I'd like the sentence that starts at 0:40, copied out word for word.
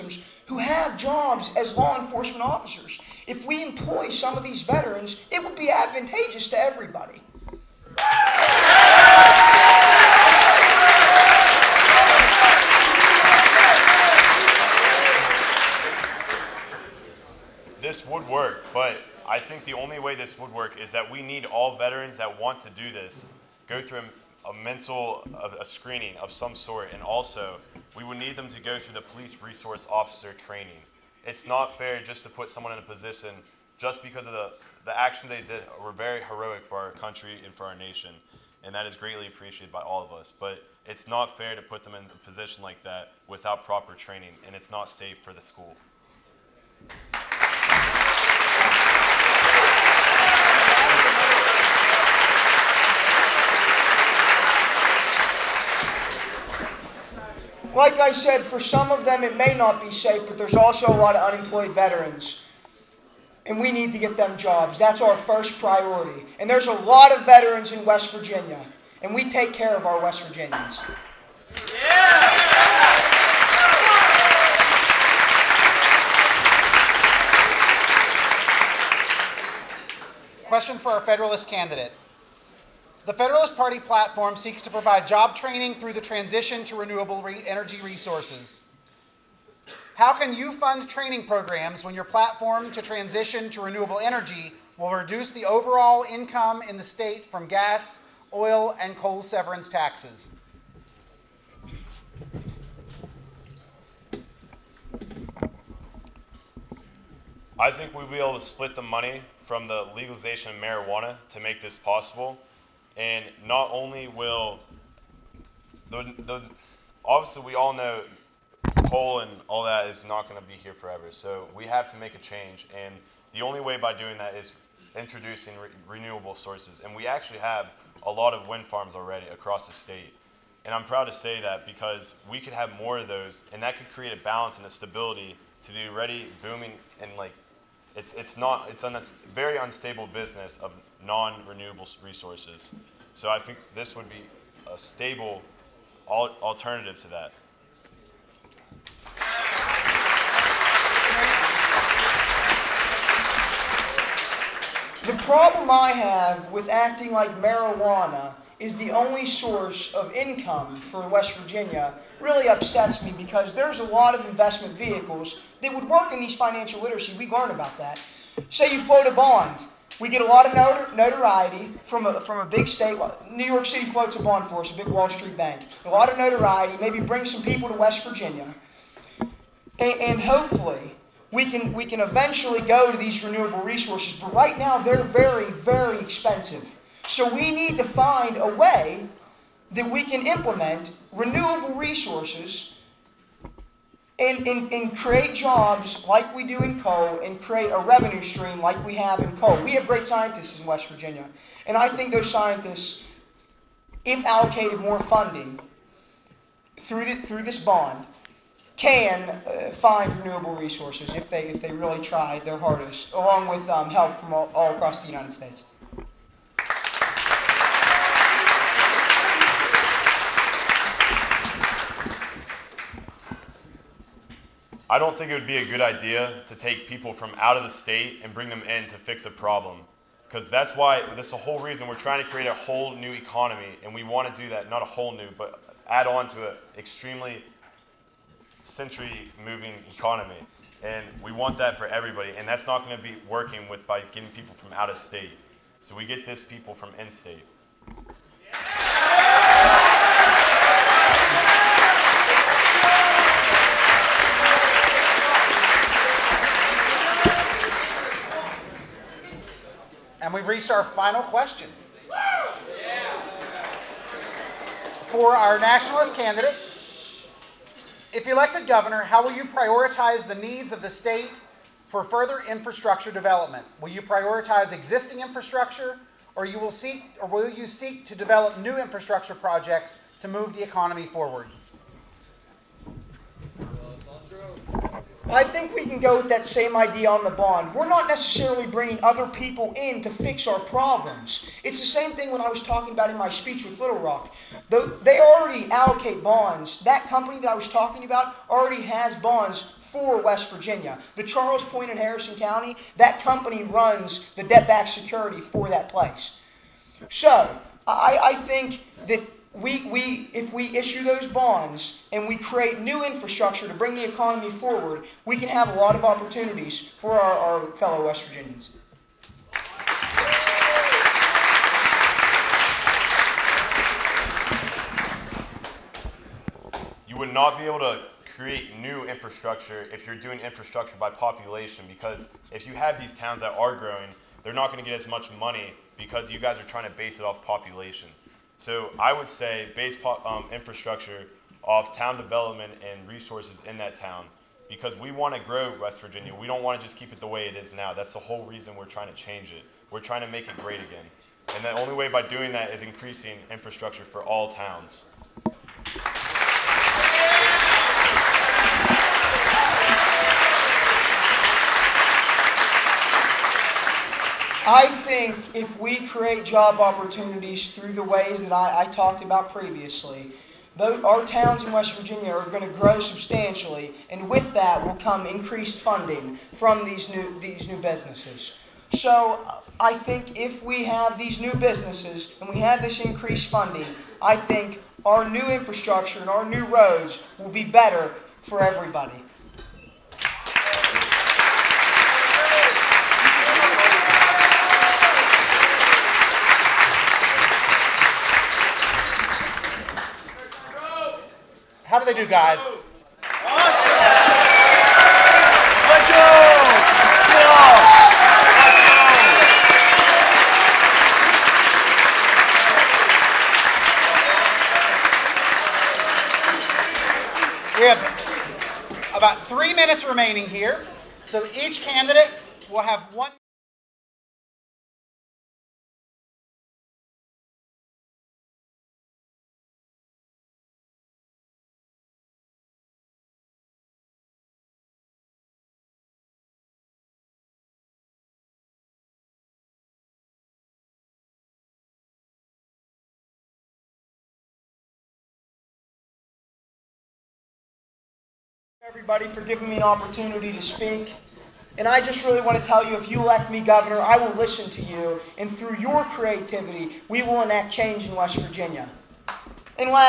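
But it's not fair to put them in a position like that without proper training, and it's not safe for the school.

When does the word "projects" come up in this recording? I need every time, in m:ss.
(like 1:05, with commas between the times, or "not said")
4:39.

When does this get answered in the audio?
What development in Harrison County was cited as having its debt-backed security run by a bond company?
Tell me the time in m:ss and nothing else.
5:01.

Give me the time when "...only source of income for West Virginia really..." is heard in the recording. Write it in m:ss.
2:38.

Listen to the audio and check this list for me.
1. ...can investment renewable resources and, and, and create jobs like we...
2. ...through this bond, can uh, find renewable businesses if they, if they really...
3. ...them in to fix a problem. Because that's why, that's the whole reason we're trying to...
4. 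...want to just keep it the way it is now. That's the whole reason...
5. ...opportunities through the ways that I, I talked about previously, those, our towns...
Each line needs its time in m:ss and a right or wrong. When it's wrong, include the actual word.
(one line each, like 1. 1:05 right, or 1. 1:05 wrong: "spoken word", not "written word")
1. 3:10 wrong: "implement", not "investment"
2. 3:27 wrong: "resources", not "businesses"
3. 3:48 right
4. 5:46 right
5. 6:06 right.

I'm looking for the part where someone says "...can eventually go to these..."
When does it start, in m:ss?
3:01.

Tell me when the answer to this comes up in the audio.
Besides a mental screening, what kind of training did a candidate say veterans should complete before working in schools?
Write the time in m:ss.
0:29.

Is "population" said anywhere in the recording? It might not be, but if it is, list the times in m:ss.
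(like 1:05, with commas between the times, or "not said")
5:31, 5:37.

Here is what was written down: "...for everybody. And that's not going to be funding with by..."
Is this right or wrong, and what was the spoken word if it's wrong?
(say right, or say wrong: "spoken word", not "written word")
wrong: "working", not "funding".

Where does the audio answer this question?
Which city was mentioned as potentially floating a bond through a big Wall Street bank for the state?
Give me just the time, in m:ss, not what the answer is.
2:53.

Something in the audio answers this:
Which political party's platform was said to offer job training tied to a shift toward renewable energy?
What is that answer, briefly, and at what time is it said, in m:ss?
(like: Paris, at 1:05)
Federalist Party, at 1:23.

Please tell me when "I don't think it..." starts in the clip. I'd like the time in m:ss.
3:44.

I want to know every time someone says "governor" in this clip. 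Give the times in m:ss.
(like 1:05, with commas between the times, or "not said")
4:28, 7:33.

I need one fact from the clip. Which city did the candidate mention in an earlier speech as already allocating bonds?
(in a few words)
Little Rock.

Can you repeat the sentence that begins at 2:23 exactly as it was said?
So I think this would be a stable al alternative to that.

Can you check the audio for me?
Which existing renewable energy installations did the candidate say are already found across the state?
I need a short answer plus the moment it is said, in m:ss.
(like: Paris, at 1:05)
wind farms, at 2:08.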